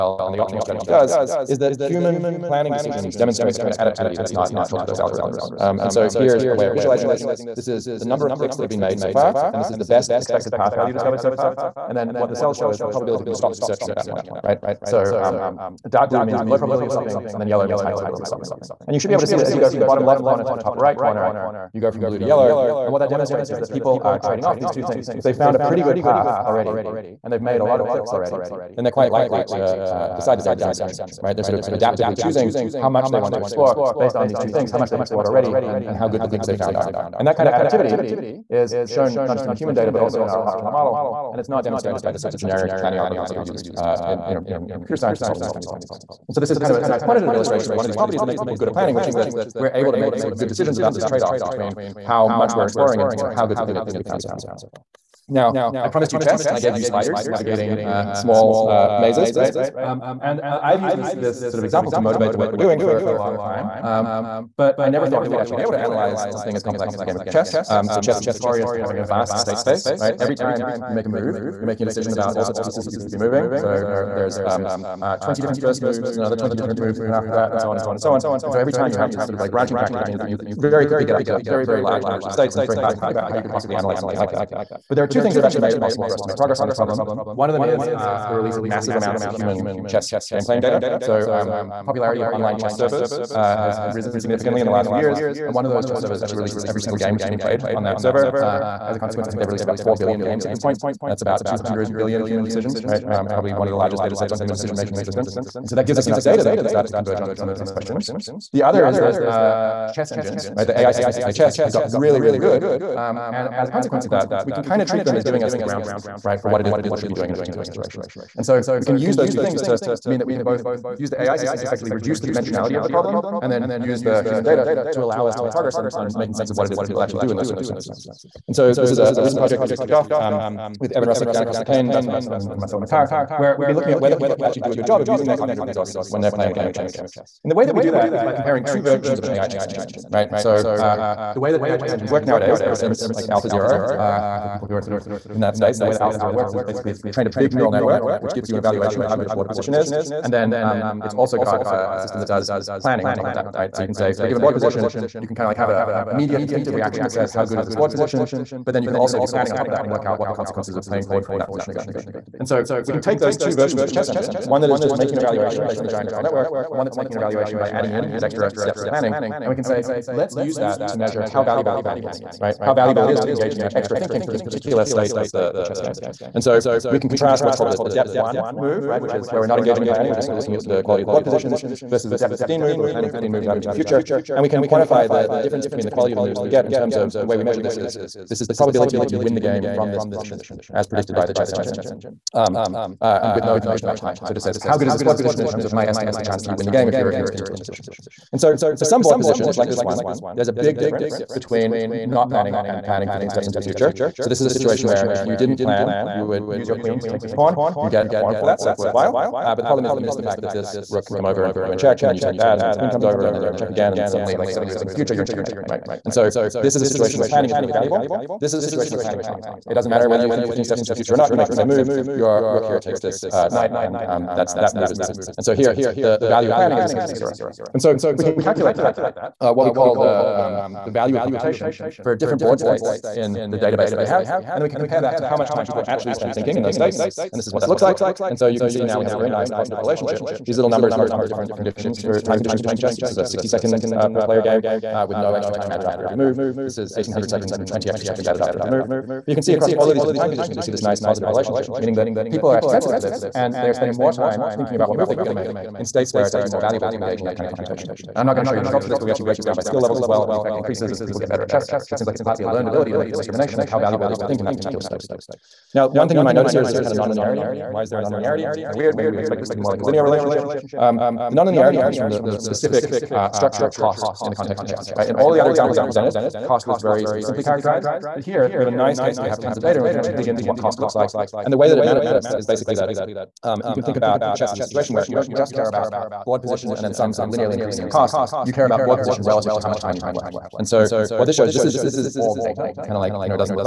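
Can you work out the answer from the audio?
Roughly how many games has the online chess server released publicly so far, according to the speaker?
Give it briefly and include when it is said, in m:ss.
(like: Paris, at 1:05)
4 billion, at 1:39.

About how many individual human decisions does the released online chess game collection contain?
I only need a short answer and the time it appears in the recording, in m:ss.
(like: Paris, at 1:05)
200 billion, at 1:41.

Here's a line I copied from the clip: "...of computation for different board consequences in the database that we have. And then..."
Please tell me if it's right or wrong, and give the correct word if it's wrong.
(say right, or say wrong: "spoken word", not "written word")
wrong: "states", not "consequences".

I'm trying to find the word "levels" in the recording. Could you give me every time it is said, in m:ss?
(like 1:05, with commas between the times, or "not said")
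4:19.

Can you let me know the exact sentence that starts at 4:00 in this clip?
These little numbers correspond to different conditions for time conditions for playing chess.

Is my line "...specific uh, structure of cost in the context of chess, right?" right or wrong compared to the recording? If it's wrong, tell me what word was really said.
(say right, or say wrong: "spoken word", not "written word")
right.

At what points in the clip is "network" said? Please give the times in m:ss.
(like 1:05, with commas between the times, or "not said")
2:27, 2:46.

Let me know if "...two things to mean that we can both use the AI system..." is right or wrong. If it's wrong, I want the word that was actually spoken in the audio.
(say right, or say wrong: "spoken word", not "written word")
right.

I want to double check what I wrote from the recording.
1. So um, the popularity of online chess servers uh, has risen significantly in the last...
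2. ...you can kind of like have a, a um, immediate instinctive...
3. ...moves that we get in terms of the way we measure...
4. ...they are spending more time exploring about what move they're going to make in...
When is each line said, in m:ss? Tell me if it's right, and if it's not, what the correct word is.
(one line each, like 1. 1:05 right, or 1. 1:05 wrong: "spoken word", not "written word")
1. 1:30 right
2. 2:35 right
3. 3:06 right
4. 4:13 wrong: "thinking", not "exploring".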